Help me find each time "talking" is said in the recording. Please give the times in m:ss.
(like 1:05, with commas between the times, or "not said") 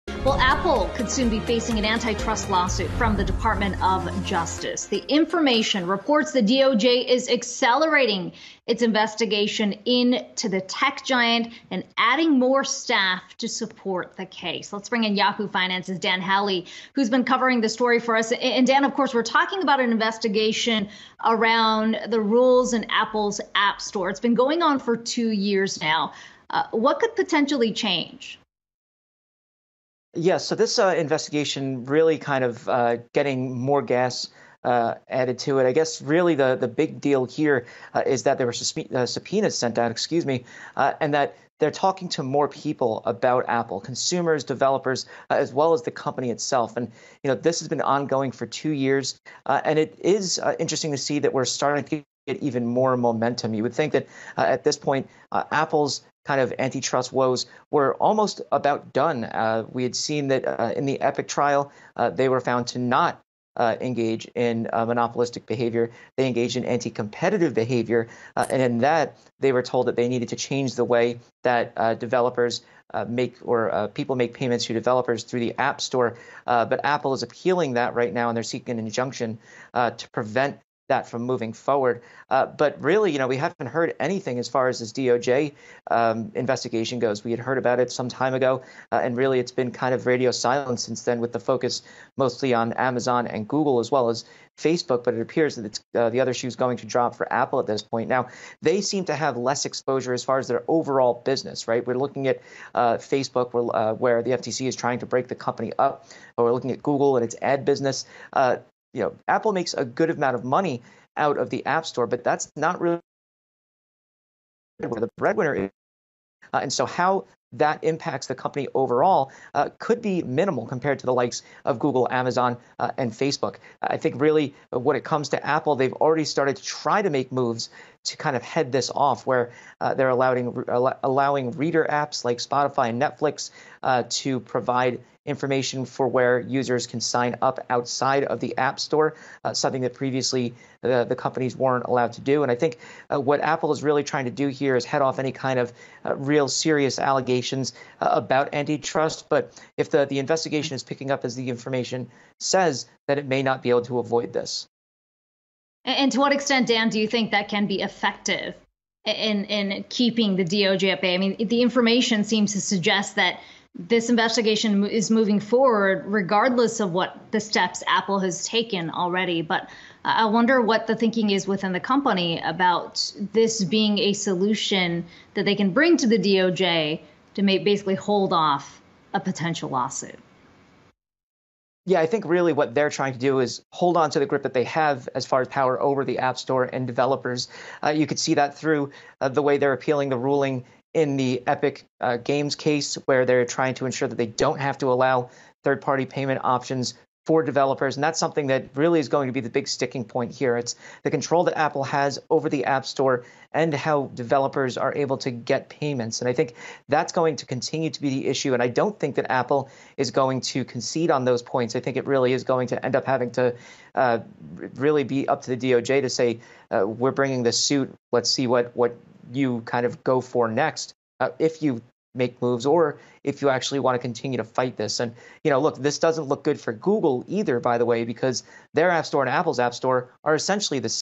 0:19, 0:41.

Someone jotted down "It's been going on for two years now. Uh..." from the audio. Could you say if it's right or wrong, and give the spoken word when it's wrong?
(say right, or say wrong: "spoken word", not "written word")
right.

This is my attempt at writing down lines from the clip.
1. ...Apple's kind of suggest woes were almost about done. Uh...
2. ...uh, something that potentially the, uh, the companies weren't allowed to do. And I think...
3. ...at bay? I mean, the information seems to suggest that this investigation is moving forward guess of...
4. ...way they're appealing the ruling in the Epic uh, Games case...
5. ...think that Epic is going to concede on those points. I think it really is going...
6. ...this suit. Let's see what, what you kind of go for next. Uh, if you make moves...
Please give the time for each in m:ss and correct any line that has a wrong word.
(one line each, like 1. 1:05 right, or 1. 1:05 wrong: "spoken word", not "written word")
1. 0:55 wrong: "antitrust", not "suggest"
2. 2:19 wrong: "previously", not "potentially"
3. 2:40 wrong: "regardless", not "guess"
4. 3:09 right
5. 3:28 wrong: "Apple", not "Epic"
6. 3:37 right.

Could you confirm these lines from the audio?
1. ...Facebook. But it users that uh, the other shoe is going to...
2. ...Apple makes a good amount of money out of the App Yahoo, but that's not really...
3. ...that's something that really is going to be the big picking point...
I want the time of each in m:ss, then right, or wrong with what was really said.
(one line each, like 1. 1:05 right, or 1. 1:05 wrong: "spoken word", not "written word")
1. 1:34 wrong: "appears", not "users"
2. 1:49 wrong: "Store", not "Yahoo"
3. 3:18 wrong: "sticking", not "picking".